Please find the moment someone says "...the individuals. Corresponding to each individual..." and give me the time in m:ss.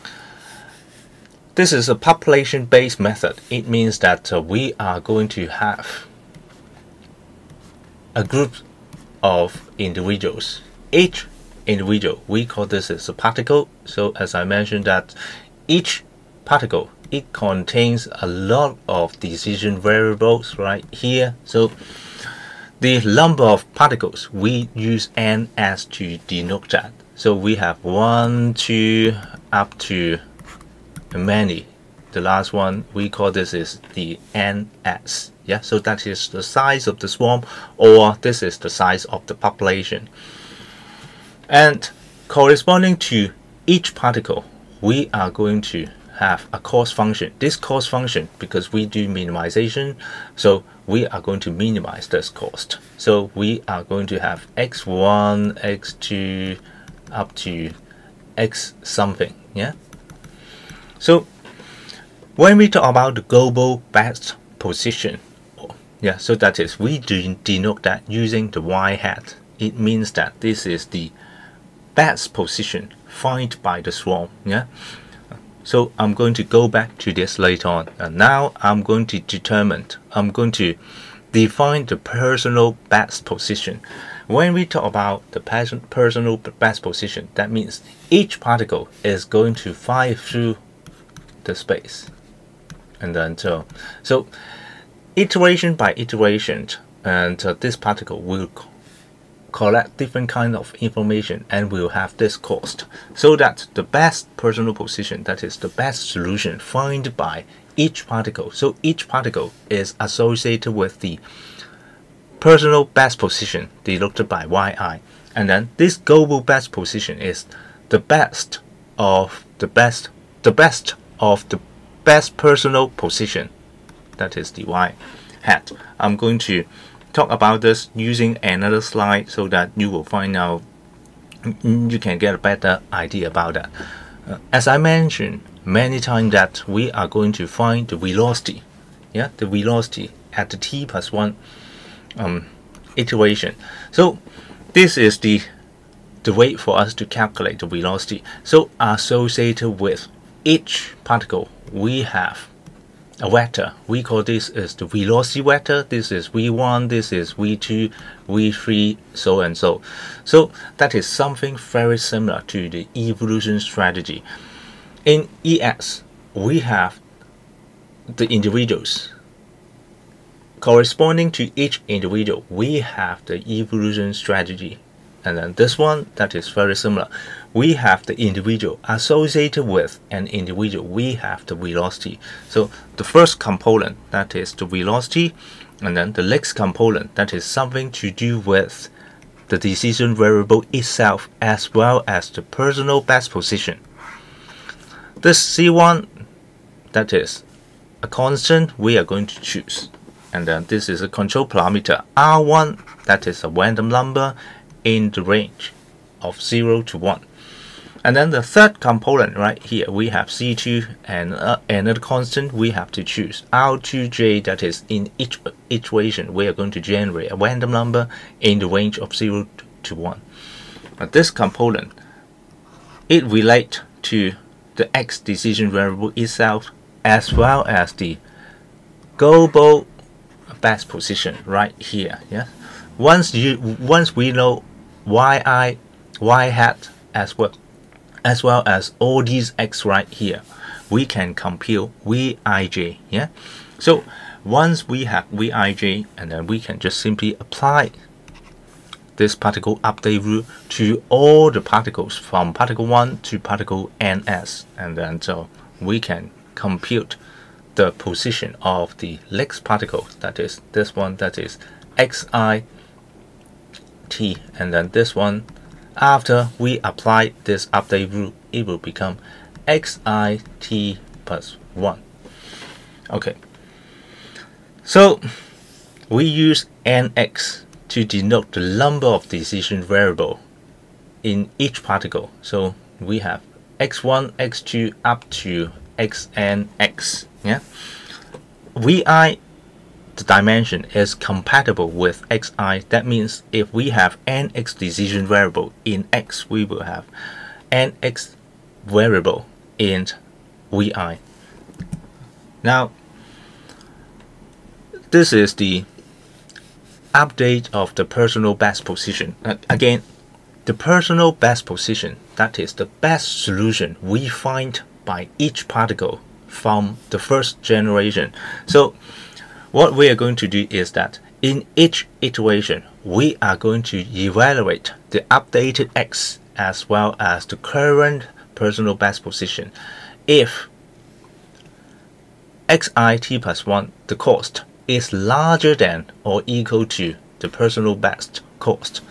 2:48.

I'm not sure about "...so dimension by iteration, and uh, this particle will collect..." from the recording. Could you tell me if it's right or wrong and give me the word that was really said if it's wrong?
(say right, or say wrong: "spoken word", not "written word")
wrong: "iteration", not "dimension".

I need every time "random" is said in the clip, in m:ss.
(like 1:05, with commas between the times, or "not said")
3:23, 3:37.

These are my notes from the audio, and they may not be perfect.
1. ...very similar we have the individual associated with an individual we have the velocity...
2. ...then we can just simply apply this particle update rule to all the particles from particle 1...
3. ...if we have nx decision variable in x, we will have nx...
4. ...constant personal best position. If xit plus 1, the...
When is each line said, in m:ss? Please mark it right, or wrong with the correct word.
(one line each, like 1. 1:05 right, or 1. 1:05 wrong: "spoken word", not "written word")
1. 2:56 right
2. 4:06 right
3. 4:53 right
4. 5:27 wrong: "current", not "constant".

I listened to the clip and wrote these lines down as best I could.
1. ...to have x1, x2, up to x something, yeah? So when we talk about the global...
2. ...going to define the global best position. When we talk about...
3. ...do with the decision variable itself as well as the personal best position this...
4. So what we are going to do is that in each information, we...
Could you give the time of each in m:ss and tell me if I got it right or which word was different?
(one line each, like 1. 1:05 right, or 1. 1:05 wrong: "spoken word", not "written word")
1. 0:54 right
2. 1:20 wrong: "personal", not "global"
3. 3:08 right
4. 5:18 wrong: "iteration", not "information".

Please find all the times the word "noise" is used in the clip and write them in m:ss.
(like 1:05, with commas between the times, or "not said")
not said.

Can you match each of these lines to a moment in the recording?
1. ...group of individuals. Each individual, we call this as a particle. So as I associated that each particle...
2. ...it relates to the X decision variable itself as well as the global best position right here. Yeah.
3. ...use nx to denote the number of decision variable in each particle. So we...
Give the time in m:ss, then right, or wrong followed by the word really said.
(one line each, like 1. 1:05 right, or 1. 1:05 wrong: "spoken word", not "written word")
1. 0:08 wrong: "mentioned", not "associated"
2. 3:43 right
3. 4:36 right.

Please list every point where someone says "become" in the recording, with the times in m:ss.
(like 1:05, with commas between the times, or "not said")
4:28.